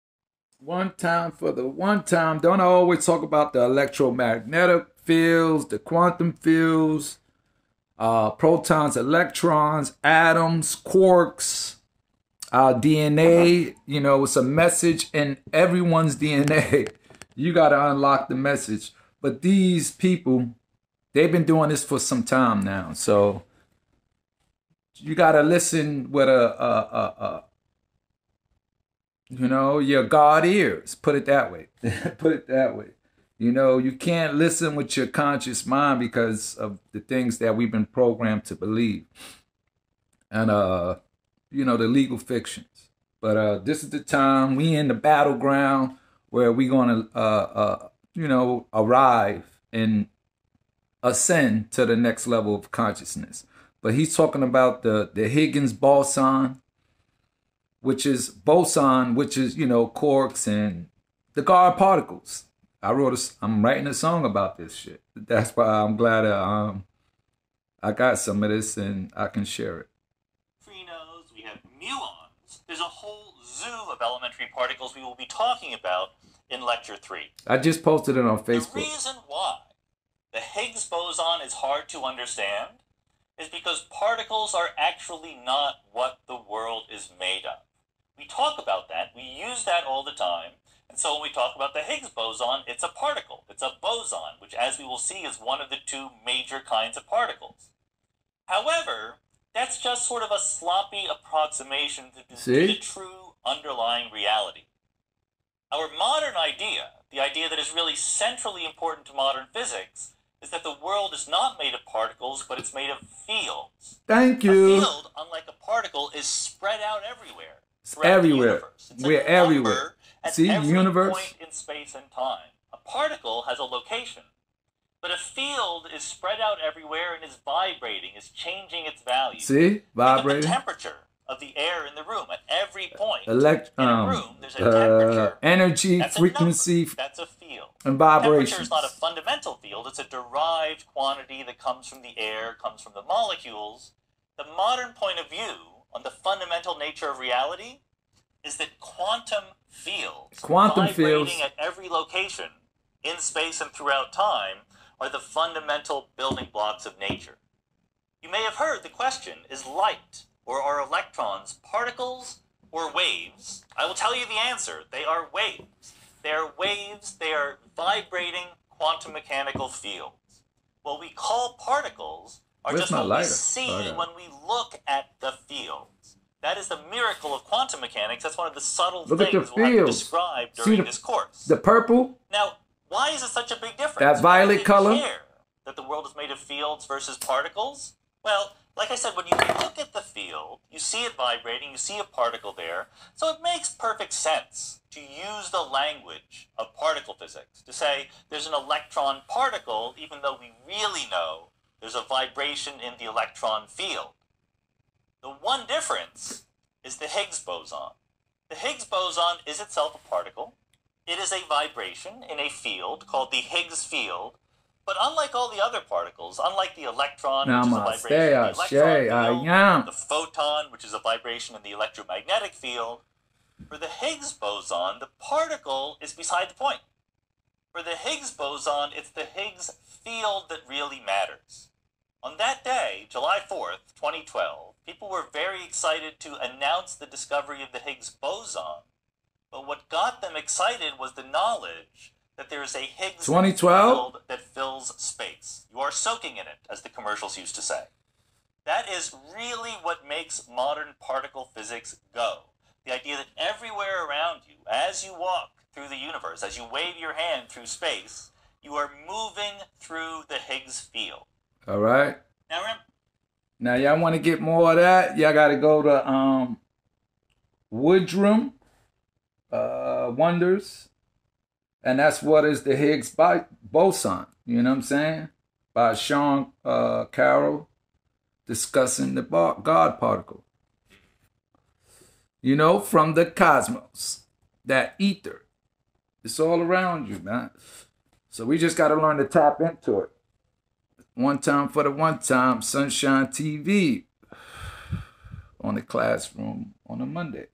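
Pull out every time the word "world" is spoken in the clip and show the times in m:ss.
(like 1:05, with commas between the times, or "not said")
1:26, 1:50, 3:05.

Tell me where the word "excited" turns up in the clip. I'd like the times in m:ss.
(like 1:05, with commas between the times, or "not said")
3:55, 4:00.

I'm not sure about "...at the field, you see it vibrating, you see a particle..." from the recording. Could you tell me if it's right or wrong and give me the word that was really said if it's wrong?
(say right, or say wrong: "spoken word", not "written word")
right.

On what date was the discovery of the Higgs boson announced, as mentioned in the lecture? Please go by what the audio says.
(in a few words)
July 4th, 2012.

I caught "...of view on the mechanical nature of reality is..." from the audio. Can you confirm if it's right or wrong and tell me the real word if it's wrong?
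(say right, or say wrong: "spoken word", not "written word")
wrong: "fundamental", not "mechanical".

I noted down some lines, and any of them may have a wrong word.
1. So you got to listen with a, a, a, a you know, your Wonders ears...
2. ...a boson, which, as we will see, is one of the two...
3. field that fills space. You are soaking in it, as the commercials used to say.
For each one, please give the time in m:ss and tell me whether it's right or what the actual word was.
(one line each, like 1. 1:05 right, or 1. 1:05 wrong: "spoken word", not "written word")
1. 0:22 wrong: "God", not "Wonders"
2. 1:33 right
3. 4:04 right.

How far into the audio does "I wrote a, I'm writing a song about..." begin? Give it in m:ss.
1:02.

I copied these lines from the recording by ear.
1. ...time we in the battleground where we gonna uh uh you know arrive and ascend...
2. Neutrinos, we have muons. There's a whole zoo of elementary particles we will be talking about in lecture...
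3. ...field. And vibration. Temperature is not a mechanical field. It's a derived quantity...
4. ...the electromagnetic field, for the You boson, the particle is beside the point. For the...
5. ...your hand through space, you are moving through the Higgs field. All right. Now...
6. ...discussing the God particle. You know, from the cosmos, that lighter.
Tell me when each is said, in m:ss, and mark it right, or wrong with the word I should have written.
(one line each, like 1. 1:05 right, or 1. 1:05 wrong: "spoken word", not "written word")
1. 0:43 right
2. 1:10 right
3. 2:17 wrong: "fundamental", not "mechanical"
4. 3:41 wrong: "Higgs", not "You"
5. 4:16 right
6. 4:38 wrong: "ether", not "lighter".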